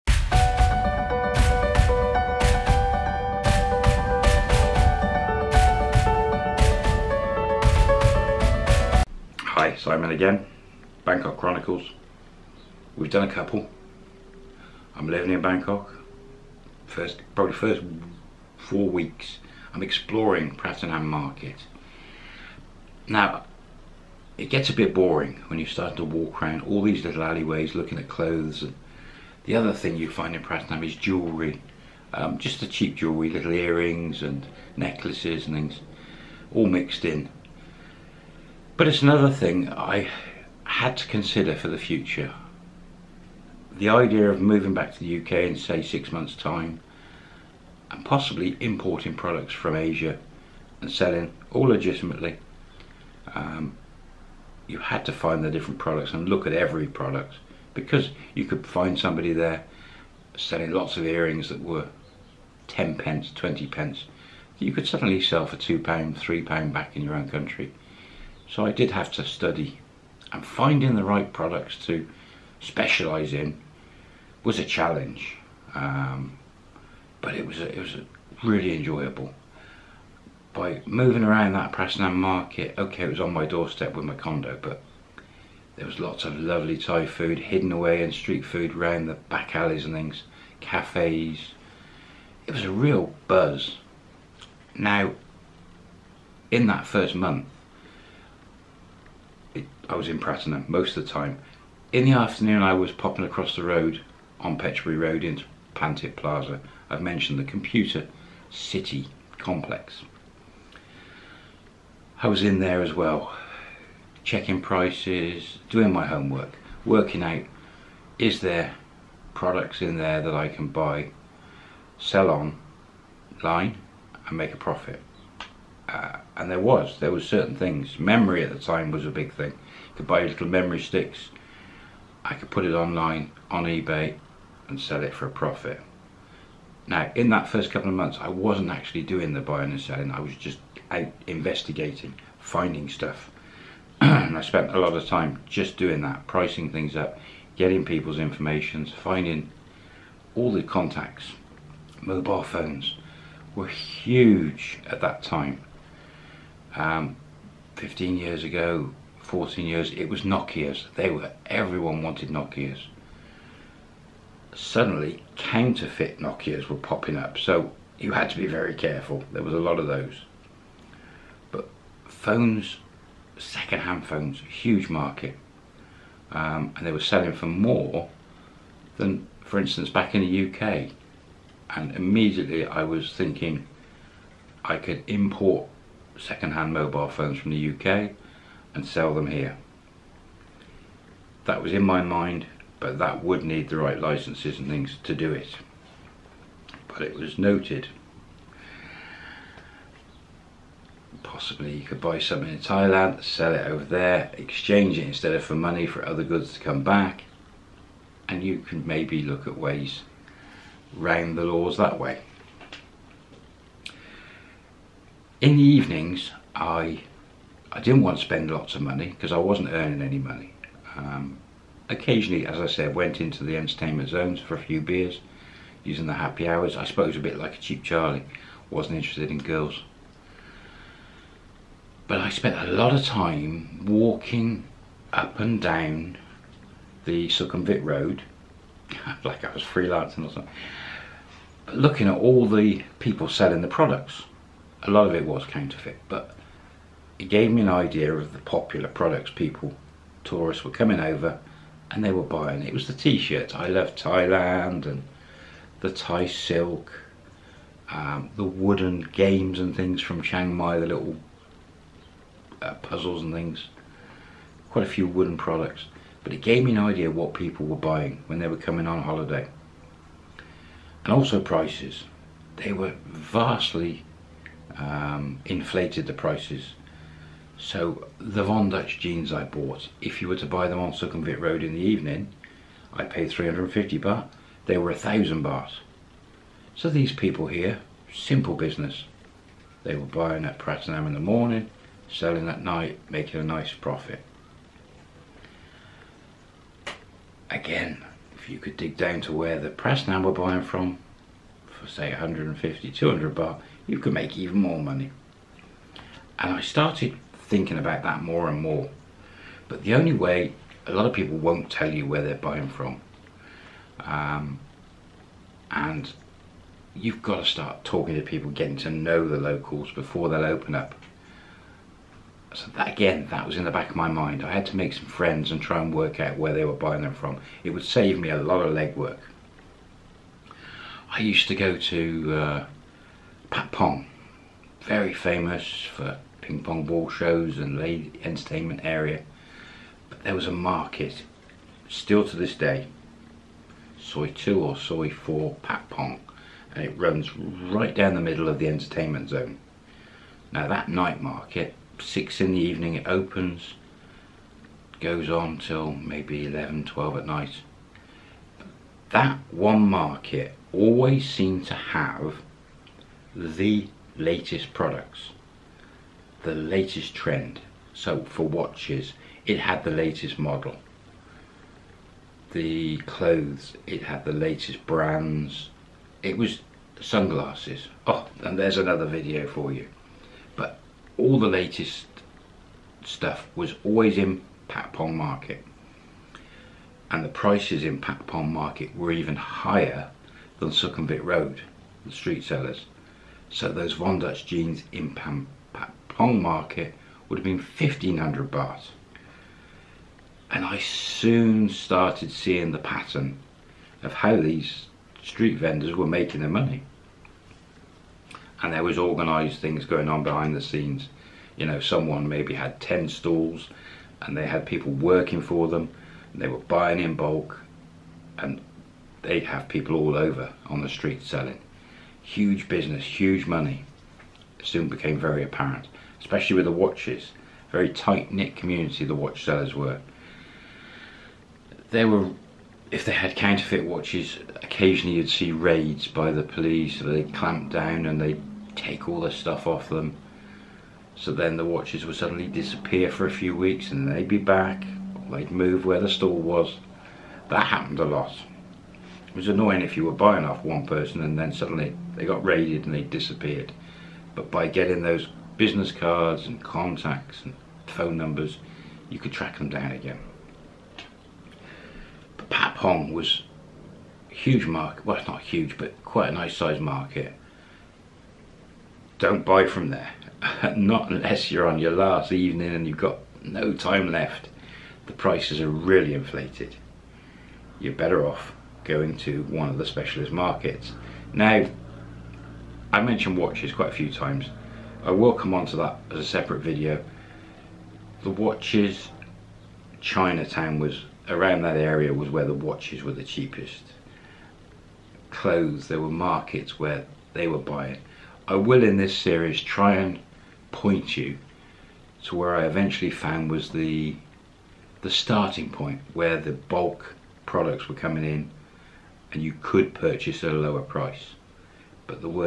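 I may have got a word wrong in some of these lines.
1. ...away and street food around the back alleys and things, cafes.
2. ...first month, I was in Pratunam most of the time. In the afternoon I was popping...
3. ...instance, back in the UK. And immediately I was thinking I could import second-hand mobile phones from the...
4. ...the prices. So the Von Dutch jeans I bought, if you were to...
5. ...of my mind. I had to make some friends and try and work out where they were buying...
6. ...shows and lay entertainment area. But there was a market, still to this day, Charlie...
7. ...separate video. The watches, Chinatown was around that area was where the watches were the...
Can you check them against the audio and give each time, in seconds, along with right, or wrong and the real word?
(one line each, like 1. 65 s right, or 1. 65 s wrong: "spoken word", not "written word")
1. 87 s right
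2. 96 s right
3. 179 s right
4. 276 s right
5. 323 s right
6. 337 s wrong: "Soi", not "Charlie"
7. 486 s right.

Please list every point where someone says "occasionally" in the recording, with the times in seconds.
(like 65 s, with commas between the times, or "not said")
221 s, 434 s.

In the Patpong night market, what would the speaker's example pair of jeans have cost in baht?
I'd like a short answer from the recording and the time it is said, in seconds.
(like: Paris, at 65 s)
1500 baht, at 397 s.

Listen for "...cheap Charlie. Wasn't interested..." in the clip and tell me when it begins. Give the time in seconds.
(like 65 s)
227 s.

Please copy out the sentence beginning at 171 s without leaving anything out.
But phones, second-hand phones, huge market.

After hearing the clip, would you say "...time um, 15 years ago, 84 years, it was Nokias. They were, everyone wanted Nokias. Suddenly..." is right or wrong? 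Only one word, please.
wrong.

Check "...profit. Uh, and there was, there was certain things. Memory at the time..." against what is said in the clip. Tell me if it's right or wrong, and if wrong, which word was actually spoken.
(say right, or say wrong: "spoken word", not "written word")
right.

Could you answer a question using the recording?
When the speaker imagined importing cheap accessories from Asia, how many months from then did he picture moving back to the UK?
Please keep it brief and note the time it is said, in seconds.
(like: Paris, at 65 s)
6, at 45 s.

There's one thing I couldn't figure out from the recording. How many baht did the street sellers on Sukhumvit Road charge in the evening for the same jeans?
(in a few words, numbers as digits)
1000 baht.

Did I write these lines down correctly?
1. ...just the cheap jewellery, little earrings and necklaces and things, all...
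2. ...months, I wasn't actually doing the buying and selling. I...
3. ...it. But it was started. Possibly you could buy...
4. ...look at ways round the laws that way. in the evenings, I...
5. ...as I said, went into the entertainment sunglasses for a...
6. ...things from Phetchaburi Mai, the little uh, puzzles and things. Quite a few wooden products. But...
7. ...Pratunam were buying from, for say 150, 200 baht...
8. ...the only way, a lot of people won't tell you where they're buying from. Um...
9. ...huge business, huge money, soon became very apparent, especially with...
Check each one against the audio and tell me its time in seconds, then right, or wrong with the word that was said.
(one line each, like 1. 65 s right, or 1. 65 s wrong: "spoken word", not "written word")
1. 32 s right
2. 137 s right
3. 195 s wrong: "noted", not "started"
4. 209 s right
5. 222 s wrong: "zones", not "sunglasses"
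6. 259 s wrong: "Chiang", not "Phetchaburi"
7. 299 s right
8. 309 s right
9. 422 s right.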